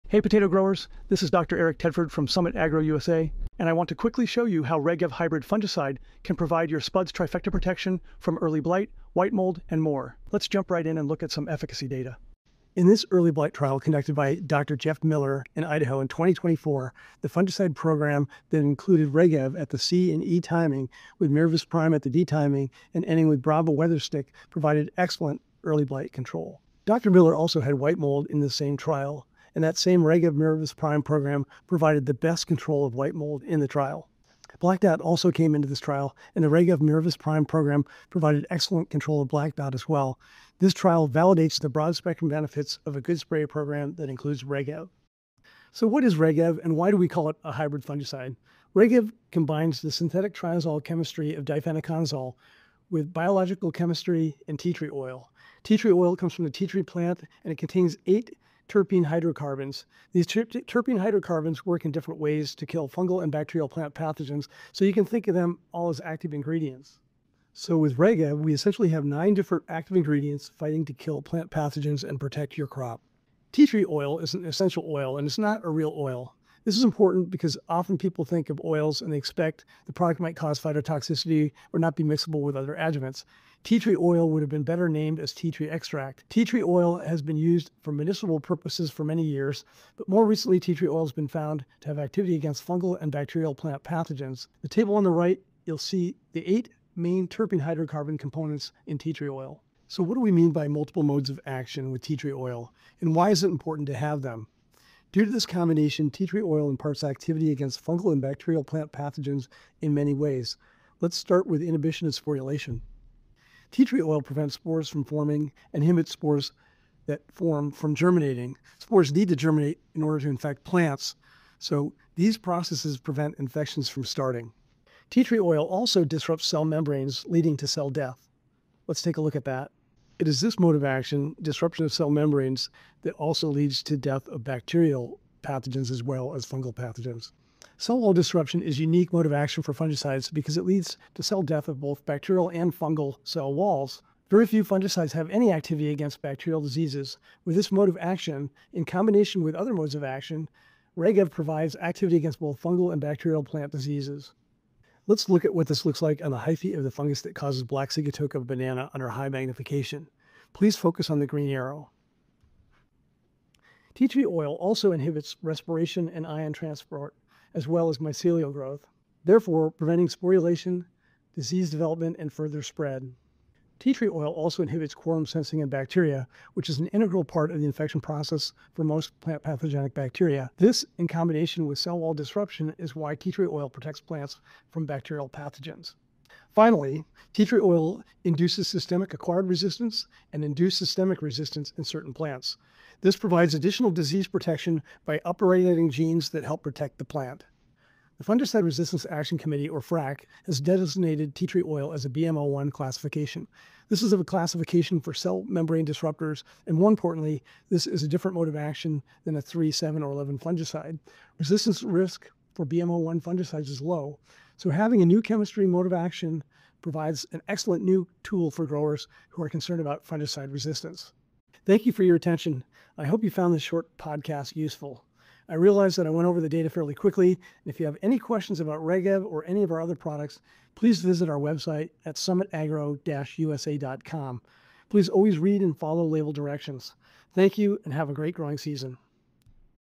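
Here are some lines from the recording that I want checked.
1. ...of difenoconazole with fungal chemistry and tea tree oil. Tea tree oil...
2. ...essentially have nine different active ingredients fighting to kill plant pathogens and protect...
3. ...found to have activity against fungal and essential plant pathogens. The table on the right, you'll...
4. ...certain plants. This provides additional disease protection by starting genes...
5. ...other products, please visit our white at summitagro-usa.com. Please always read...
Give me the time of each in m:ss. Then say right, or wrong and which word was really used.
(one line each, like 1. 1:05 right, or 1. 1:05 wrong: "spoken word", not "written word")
1. 0:51 wrong: "biological", not "fungal"
2. 1:08 right
3. 1:31 wrong: "bacterial", not "essential"
4. 3:11 wrong: "upregulating", not "starting"
5. 3:49 wrong: "website", not "white".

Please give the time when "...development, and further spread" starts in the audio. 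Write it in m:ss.
2:51.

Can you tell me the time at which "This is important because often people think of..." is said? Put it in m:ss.
1:16.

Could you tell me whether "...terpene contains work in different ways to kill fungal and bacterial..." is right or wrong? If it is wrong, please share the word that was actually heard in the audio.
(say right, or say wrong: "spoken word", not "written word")
wrong: "hydrocarbons", not "contains".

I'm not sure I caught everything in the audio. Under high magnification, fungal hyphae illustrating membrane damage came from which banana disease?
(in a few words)
Black Sigatoka.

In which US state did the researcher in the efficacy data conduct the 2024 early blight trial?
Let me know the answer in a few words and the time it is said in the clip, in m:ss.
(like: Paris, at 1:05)
Idaho, at 0:15.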